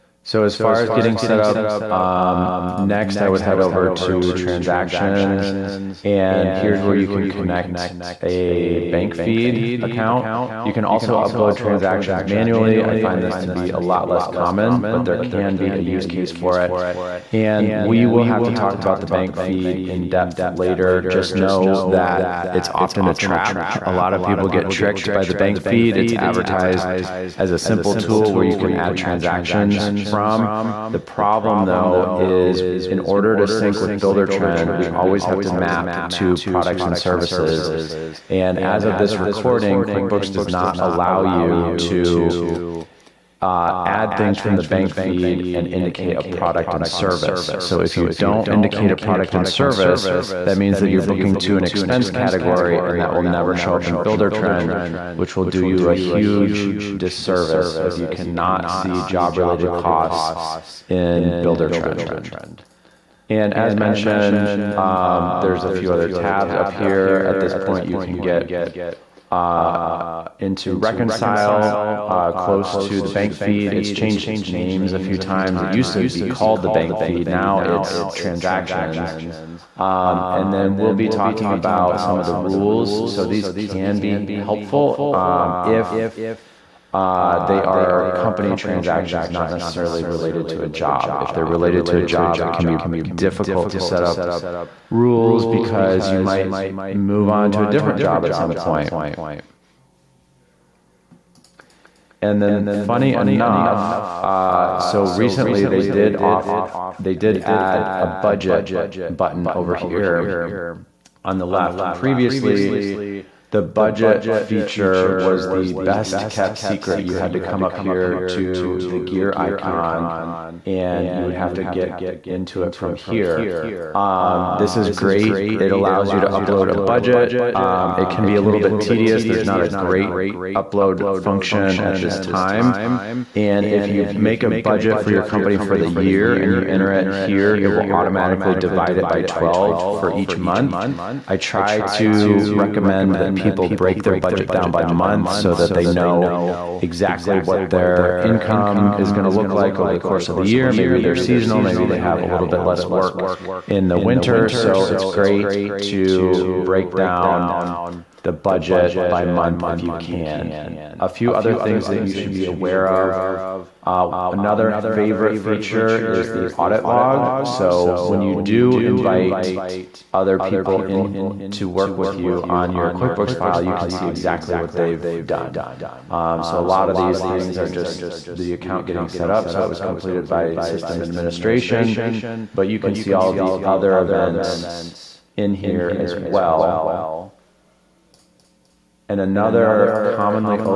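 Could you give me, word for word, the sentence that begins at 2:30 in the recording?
Maybe they're seasonal, maybe they have a little bit less work in the winter.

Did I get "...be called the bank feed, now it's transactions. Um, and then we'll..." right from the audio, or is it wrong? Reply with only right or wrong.
right.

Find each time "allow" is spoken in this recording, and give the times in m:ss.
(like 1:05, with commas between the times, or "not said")
0:40, 2:05.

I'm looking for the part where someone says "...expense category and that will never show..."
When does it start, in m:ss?
0:51.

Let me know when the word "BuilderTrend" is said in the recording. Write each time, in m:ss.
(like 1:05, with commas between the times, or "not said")
0:33, 0:53, 1:01.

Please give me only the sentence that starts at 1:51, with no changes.
Previously, the budget feature was the best kept secret.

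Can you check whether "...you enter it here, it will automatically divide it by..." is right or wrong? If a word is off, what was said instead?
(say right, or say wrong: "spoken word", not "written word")
right.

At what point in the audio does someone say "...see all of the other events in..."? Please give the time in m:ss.
3:02.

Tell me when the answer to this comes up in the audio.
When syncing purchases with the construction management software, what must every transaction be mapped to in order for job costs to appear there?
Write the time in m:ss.
0:36.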